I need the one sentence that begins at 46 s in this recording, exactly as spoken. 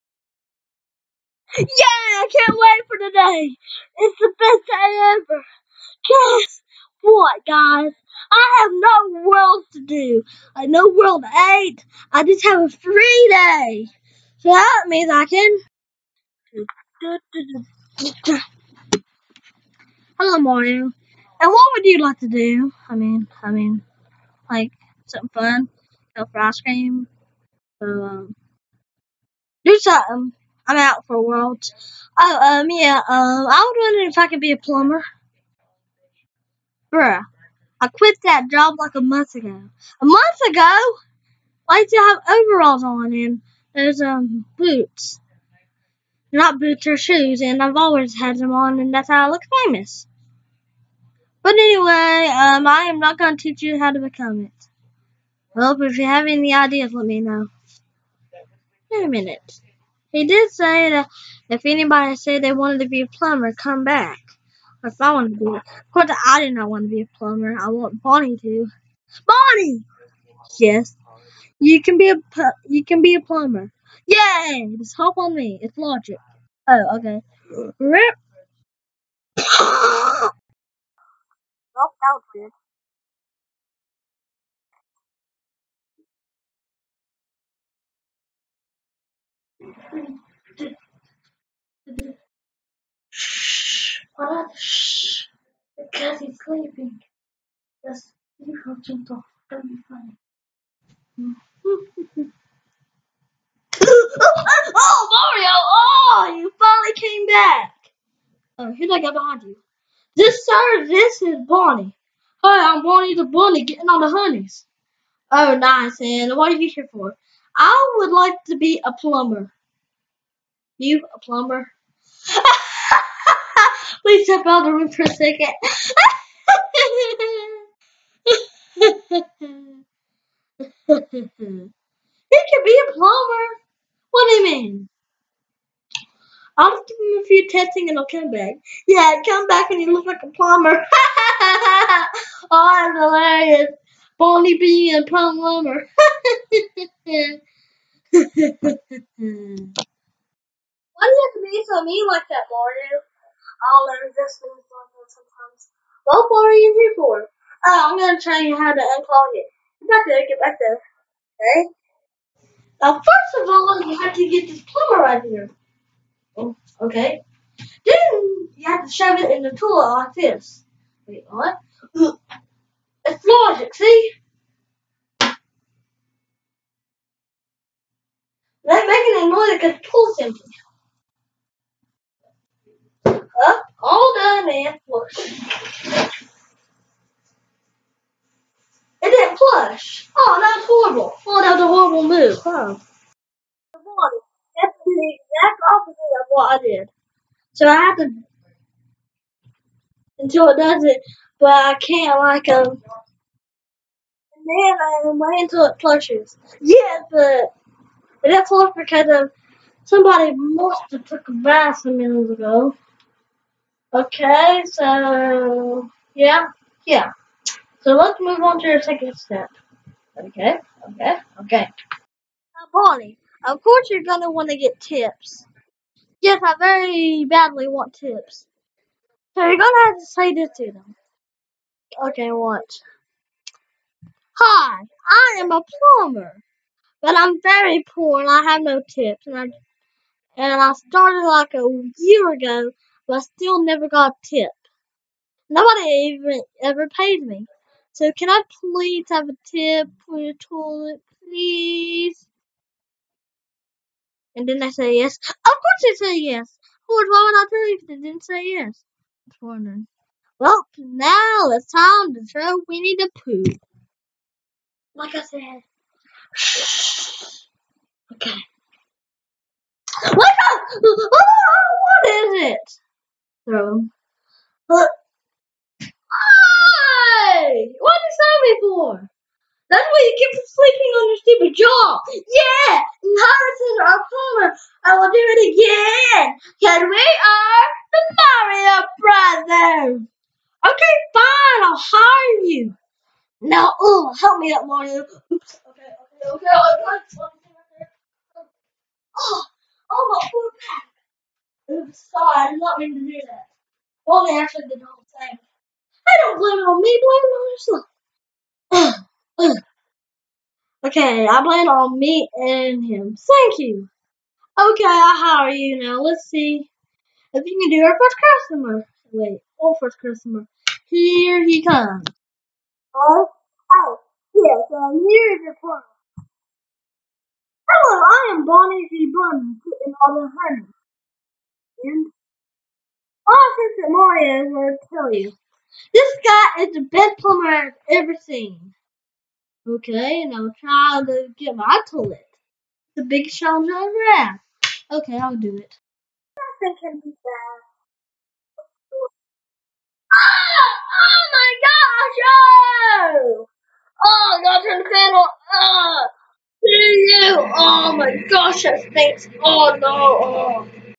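Not boots or shoes, and I've always had them on, and that's how I look famous.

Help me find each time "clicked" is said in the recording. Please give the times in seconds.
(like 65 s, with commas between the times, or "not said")
not said.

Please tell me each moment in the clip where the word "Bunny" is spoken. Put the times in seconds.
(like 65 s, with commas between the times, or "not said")
113 s, 329 s.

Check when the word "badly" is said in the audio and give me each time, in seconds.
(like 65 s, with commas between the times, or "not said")
227 s.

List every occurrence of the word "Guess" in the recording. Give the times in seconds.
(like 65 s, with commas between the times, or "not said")
6 s.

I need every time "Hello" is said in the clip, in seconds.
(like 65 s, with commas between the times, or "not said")
20 s, 327 s.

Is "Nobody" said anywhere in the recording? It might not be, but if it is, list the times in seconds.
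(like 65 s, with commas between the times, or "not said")
245 s.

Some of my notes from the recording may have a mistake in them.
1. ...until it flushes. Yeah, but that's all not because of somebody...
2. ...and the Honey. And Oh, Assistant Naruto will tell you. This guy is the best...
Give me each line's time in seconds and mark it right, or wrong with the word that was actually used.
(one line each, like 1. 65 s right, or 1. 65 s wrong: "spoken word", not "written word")
1. 205 s right
2. 329 s wrong: "Mario", not "Naruto".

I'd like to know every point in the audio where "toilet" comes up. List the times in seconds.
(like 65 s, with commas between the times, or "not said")
169 s, 250 s, 341 s.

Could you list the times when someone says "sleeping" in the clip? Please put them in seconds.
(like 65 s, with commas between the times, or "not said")
96 s, 280 s.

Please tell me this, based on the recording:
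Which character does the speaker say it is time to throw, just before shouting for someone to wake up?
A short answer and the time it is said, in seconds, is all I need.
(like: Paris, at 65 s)
Winnie the Pooh, at 262 s.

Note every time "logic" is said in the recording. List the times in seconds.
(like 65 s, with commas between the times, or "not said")
75 s, 173 s, 179 s.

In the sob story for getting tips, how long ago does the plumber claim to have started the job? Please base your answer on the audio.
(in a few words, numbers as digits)
A year ago.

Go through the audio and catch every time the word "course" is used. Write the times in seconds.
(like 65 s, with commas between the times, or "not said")
65 s, 223 s, 255 s.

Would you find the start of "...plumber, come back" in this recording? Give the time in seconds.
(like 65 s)
63 s.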